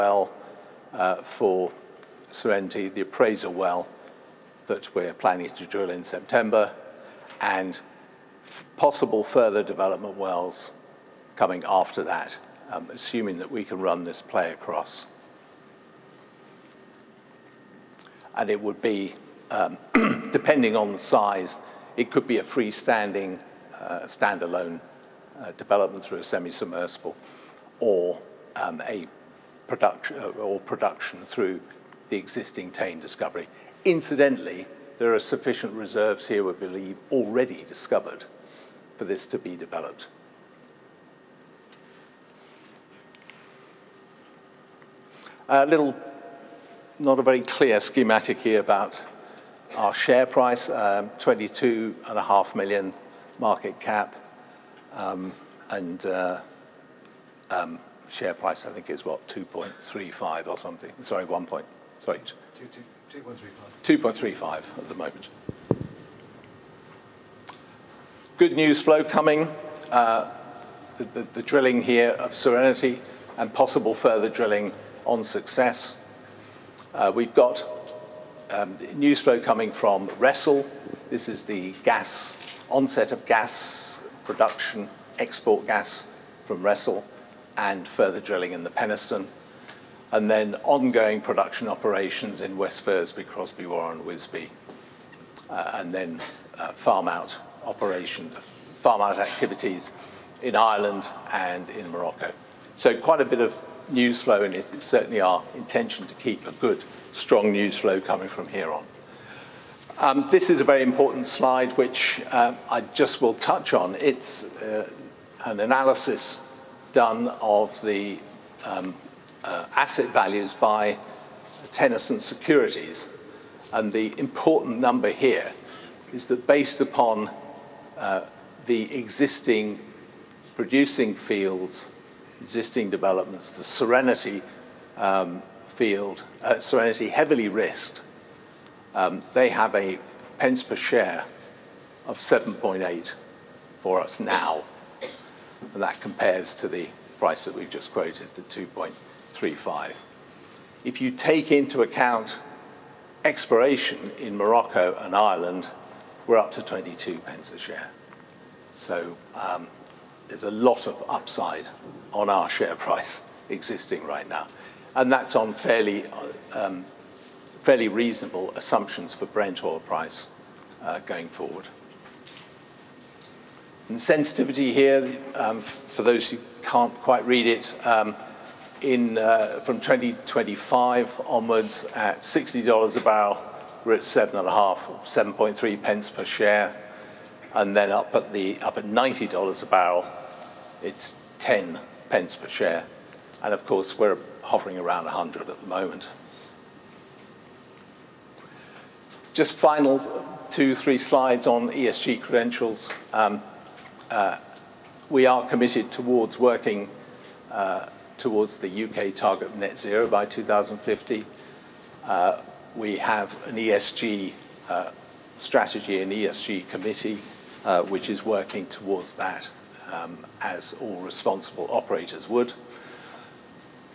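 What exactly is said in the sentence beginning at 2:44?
And that's on fairly, um, fairly reasonable assumptions for Brent oil price uh, going forward.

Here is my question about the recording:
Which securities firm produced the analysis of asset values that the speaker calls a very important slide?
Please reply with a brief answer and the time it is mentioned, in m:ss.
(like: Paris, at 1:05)
Tennyson Securities, at 2:01.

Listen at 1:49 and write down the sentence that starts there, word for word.
Um, this is a very important slide, which uh, I just will touch on.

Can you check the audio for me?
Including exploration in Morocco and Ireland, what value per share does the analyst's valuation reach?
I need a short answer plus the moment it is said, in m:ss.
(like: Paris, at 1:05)
22 pence, at 2:36.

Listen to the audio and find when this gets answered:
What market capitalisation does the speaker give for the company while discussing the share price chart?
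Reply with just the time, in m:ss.
0:51.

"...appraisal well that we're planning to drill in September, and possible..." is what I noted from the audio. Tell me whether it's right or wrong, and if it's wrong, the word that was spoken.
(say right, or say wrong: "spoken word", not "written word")
right.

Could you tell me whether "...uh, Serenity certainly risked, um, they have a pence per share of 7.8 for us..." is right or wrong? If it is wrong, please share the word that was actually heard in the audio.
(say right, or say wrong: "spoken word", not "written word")
wrong: "heavily", not "certainly".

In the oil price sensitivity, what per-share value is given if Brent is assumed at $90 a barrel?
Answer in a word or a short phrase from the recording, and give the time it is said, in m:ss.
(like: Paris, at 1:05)
10 pence, at 3:11.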